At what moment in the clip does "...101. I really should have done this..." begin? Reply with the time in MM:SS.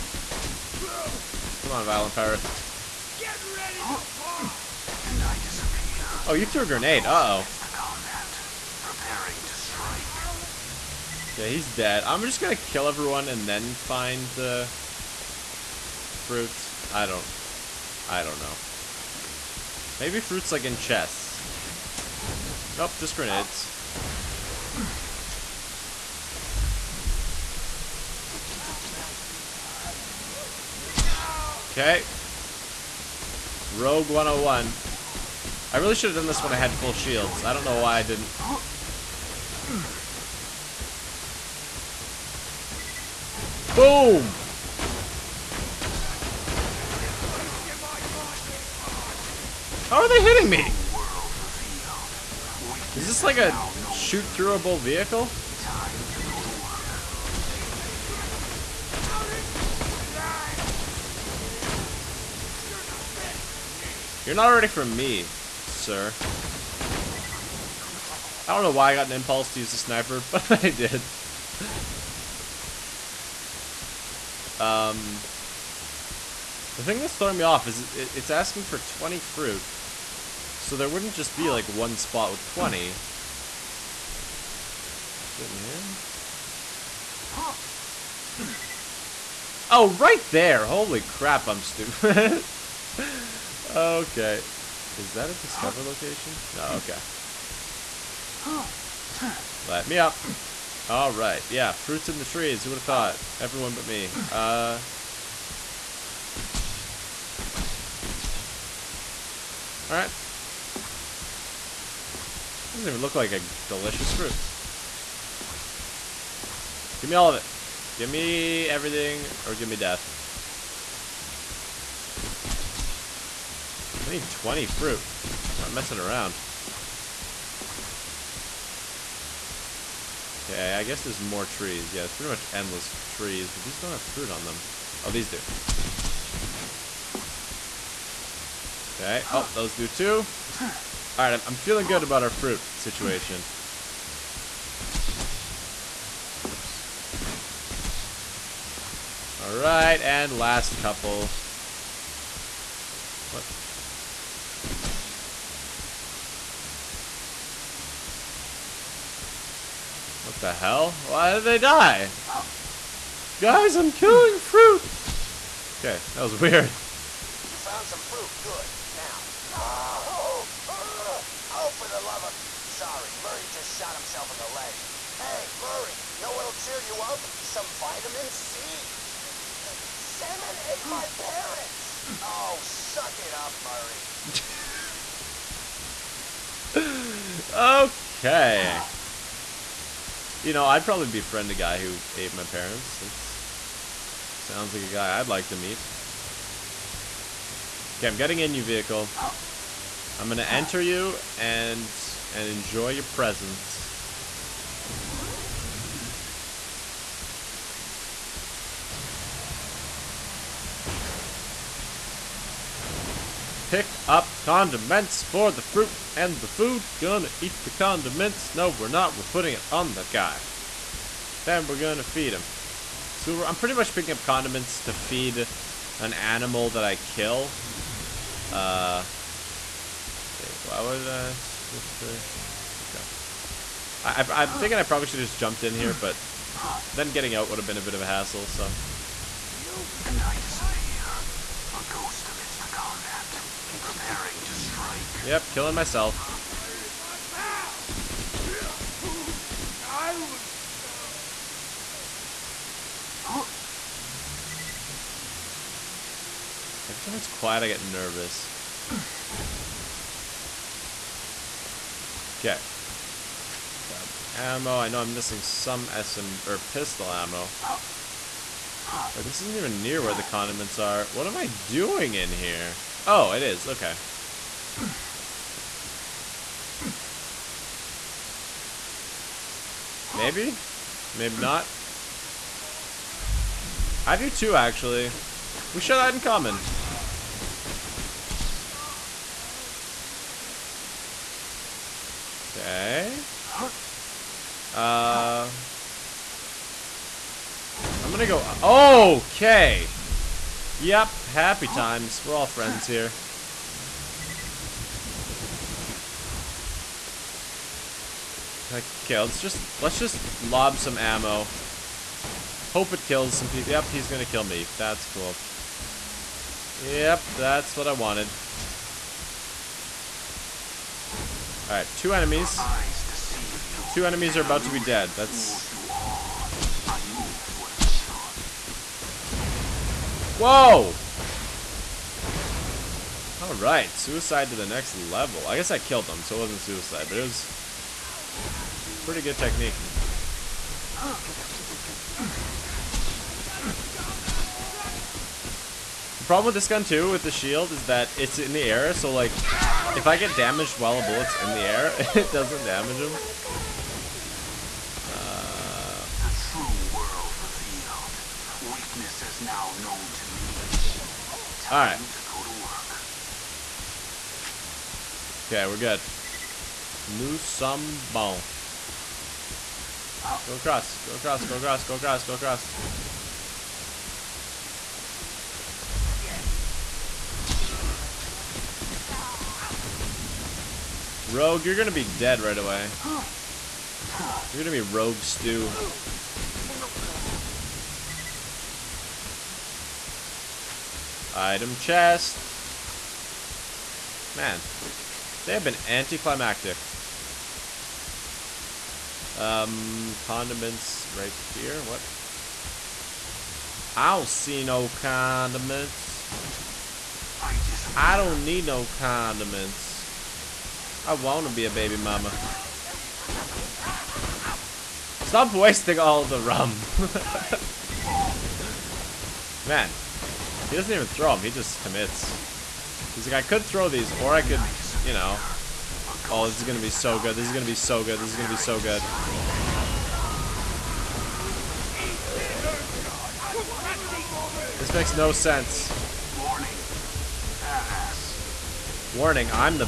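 00:34.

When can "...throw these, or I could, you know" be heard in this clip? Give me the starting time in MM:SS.
07:03.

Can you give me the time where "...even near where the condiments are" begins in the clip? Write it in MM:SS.
04:29.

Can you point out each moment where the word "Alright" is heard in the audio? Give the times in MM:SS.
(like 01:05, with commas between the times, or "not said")
01:40, 01:49, 05:21, 05:33.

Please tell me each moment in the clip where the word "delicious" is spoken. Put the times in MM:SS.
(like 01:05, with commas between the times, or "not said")
01:53.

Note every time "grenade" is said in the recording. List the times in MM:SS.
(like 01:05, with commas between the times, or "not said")
00:06, 00:23.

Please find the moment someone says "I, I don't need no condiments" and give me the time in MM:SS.
06:47.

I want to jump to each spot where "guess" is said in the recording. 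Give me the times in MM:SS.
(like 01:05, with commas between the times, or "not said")
02:10, 05:35.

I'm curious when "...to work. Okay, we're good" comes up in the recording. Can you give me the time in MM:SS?
06:02.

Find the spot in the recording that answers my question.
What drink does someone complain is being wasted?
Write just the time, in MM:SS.
06:56.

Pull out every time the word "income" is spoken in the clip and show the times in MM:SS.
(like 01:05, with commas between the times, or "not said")
not said.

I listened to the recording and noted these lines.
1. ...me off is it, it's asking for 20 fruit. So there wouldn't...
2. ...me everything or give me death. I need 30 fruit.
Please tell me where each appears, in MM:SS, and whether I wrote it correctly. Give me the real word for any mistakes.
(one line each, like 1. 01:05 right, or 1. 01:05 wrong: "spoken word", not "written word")
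1. 01:17 right
2. 01:58 wrong: "20", not "30".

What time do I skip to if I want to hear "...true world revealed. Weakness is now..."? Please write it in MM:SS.
05:56.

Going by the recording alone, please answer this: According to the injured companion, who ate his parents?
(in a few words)
Sandman.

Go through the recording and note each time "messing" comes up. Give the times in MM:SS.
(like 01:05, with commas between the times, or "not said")
02:05.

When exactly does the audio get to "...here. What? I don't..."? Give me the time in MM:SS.
06:41.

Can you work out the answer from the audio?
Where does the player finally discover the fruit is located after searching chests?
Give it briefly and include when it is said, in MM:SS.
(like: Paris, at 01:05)
In the trees, at 01:41.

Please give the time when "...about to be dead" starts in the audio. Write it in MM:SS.
05:24.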